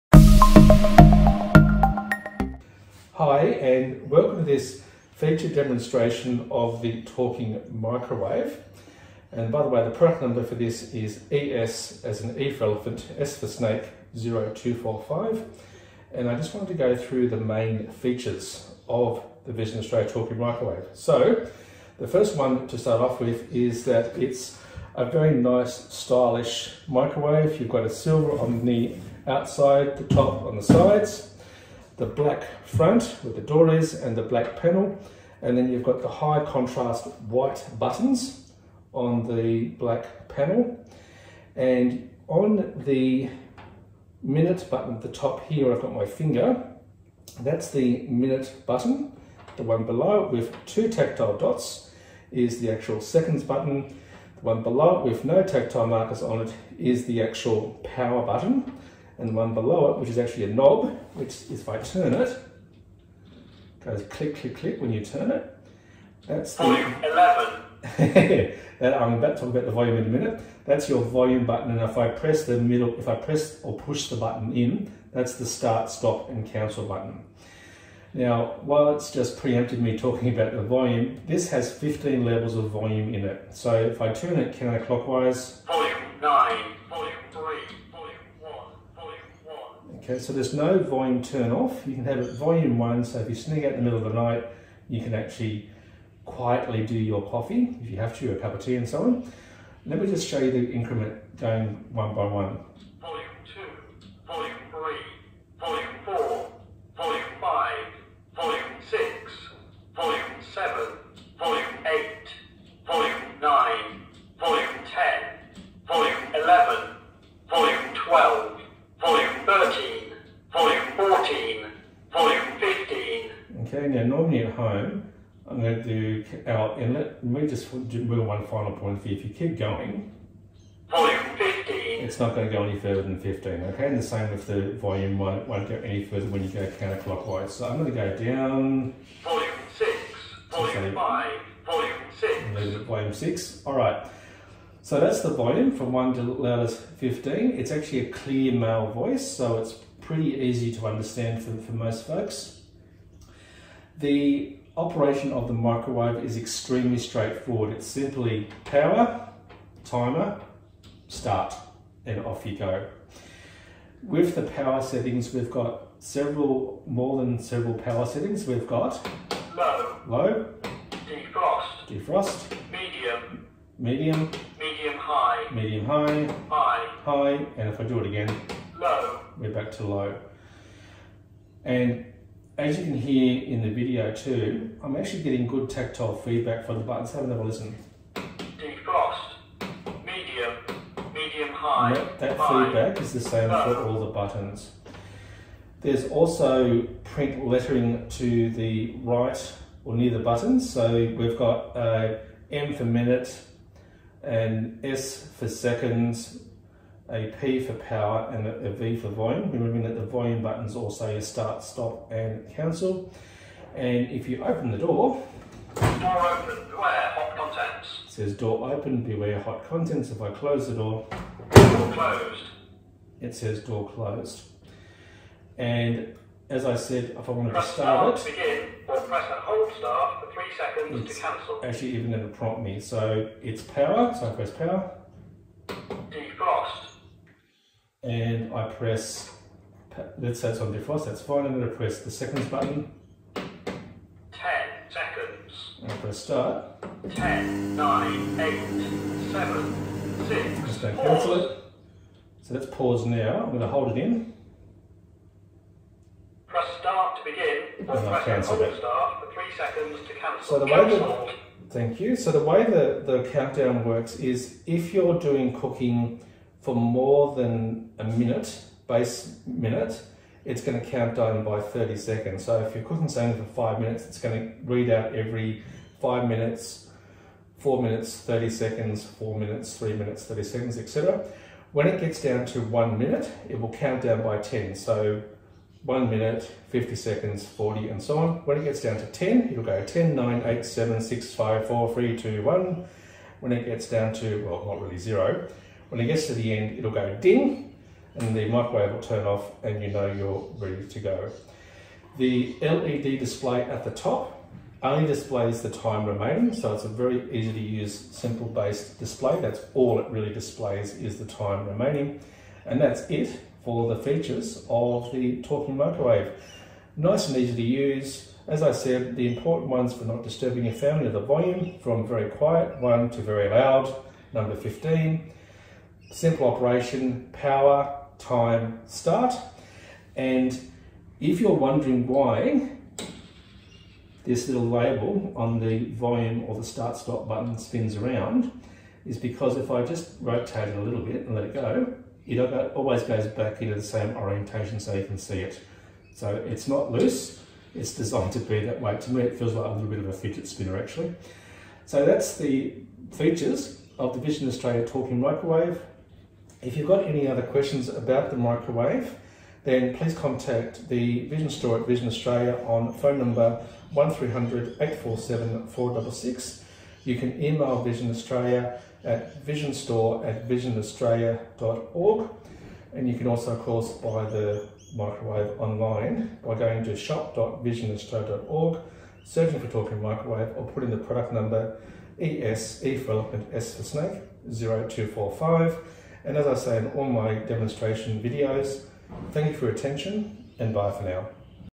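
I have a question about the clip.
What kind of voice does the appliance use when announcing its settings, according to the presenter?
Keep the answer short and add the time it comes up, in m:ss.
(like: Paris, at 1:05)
clear male voice, at 2:28.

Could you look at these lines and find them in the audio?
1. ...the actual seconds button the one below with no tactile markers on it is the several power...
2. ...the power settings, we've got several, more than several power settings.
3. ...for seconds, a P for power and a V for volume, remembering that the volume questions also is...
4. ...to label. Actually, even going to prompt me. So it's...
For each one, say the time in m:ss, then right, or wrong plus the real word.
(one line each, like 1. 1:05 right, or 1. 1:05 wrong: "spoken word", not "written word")
1. 0:52 wrong: "actual", not "several"
2. 2:44 right
3. 3:25 wrong: "buttons", not "questions"
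4. 3:51 wrong: "cancel", not "label".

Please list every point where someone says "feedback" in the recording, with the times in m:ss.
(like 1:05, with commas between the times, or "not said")
3:06, 3:12.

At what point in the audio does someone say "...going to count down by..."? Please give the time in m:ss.
4:30.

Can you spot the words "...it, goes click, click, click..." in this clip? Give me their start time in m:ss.
1:02.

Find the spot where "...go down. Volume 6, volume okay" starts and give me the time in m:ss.
2:17.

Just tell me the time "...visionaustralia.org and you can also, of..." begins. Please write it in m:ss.
6:10.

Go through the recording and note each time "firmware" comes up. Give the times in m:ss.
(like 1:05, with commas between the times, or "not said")
not said.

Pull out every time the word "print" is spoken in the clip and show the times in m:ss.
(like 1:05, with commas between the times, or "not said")
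3:17.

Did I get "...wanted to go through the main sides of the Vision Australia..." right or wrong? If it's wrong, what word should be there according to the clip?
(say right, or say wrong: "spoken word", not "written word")
wrong: "features", not "sides".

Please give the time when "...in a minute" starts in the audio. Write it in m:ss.
1:09.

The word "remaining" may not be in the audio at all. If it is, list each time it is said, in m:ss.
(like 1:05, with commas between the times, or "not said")
5:06, 5:11.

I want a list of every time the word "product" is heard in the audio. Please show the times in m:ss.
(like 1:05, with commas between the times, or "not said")
0:09, 6:20.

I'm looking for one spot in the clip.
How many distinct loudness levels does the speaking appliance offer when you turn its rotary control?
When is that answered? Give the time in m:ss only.
1:21.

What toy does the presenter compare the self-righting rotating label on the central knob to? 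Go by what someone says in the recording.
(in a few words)
fidget spinner.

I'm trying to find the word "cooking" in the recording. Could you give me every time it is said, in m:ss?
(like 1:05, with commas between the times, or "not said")
4:25, 4:32.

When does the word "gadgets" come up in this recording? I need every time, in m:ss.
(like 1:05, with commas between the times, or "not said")
not said.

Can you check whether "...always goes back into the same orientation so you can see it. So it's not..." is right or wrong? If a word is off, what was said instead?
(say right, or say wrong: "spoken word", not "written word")
right.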